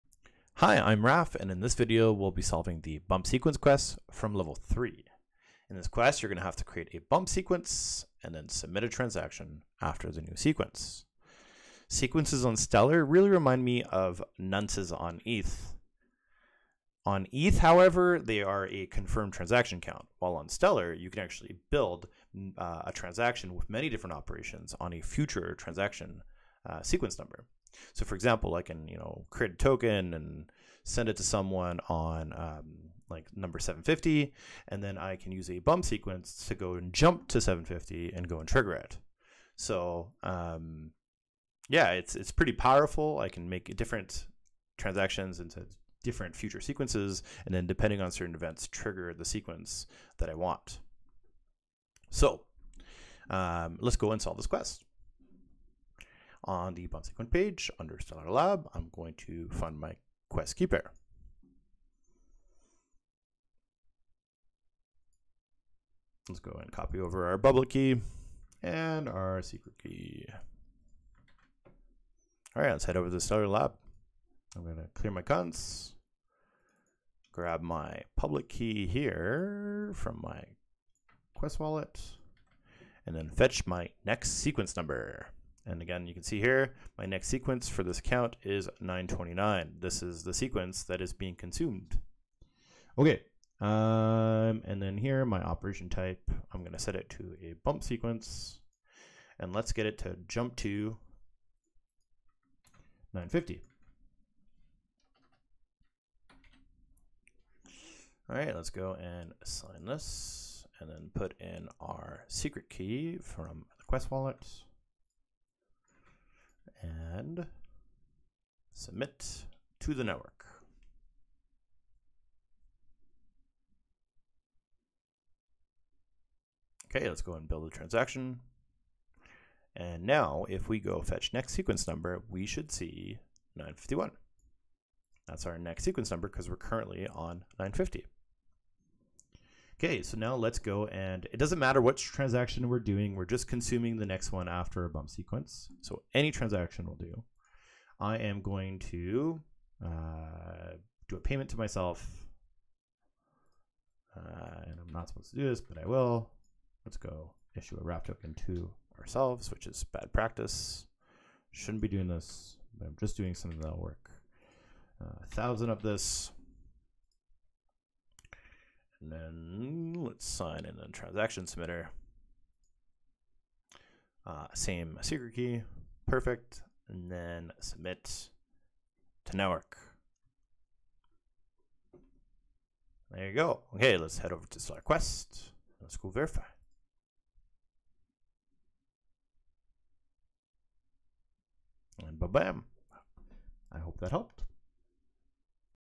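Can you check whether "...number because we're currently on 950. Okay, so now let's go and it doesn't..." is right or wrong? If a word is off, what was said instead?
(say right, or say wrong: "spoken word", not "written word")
right.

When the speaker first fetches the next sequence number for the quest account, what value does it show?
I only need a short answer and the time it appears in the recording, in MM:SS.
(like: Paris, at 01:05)
929, at 01:28.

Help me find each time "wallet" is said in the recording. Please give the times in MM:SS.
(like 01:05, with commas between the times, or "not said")
01:21, 01:54.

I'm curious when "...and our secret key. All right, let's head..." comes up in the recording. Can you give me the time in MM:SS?
01:08.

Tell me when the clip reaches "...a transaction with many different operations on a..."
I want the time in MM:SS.
00:22.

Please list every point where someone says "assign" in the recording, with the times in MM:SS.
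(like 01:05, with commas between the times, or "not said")
01:49.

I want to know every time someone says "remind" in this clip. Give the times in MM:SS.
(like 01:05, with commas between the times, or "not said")
00:13.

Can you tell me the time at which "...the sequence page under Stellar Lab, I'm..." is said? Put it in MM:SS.
00:56.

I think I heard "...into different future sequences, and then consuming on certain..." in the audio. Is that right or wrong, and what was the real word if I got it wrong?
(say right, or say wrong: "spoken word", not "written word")
wrong: "depending", not "consuming".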